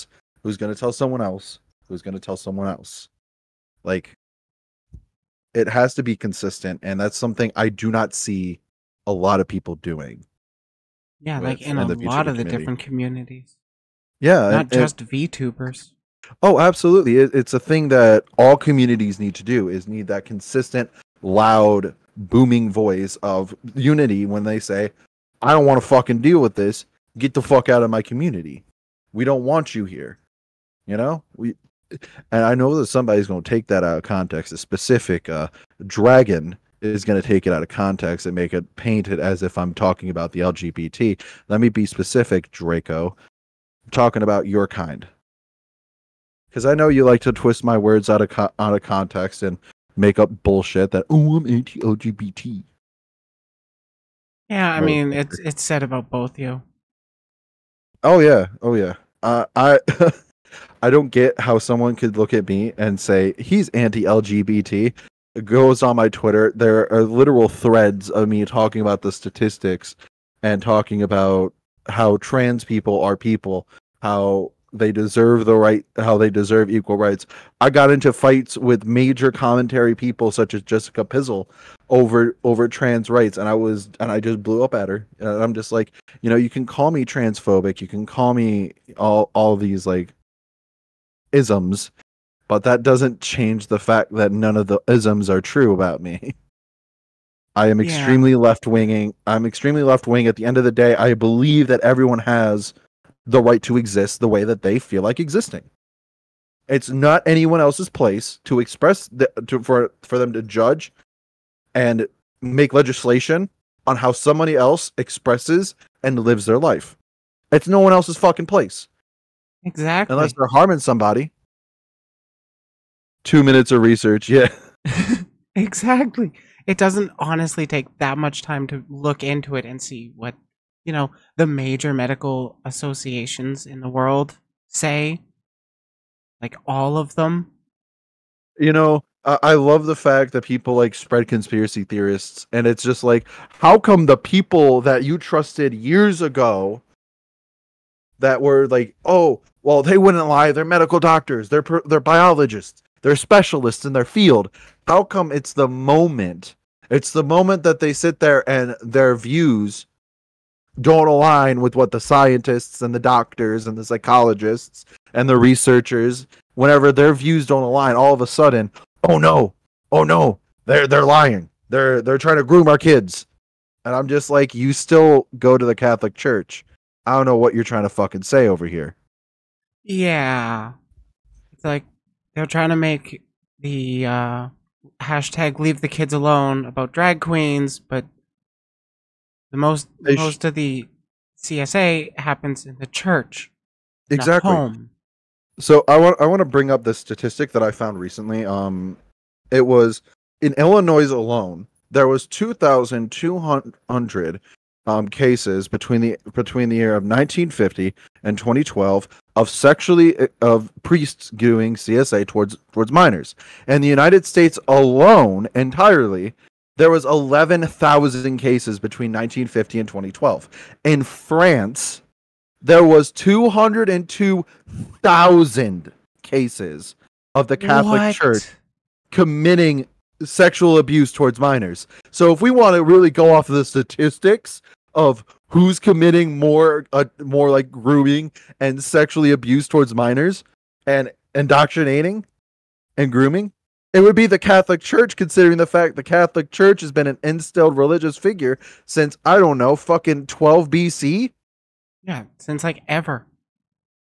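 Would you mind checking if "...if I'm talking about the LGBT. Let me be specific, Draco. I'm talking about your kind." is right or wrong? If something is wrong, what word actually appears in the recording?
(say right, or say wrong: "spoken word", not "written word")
right.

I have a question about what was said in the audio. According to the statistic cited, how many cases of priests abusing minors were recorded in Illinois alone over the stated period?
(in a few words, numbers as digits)
2,200.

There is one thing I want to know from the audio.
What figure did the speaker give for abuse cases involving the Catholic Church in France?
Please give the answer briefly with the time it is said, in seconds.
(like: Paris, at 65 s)
202,000, at 223 s.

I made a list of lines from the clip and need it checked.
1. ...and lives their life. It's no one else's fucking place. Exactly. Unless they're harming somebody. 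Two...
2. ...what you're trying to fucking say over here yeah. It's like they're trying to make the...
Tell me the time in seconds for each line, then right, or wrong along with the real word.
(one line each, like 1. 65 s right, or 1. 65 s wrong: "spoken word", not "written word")
1. 116 s right
2. 177 s right.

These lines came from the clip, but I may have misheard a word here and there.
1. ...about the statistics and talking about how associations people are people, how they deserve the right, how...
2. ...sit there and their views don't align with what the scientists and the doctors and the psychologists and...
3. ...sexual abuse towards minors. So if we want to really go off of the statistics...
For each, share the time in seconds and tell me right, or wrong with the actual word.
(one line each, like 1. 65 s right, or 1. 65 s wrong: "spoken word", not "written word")
1. 68 s wrong: "trans", not "associations"
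2. 157 s right
3. 230 s right.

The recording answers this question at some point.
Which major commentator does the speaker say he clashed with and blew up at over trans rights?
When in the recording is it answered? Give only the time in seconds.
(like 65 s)
80 s.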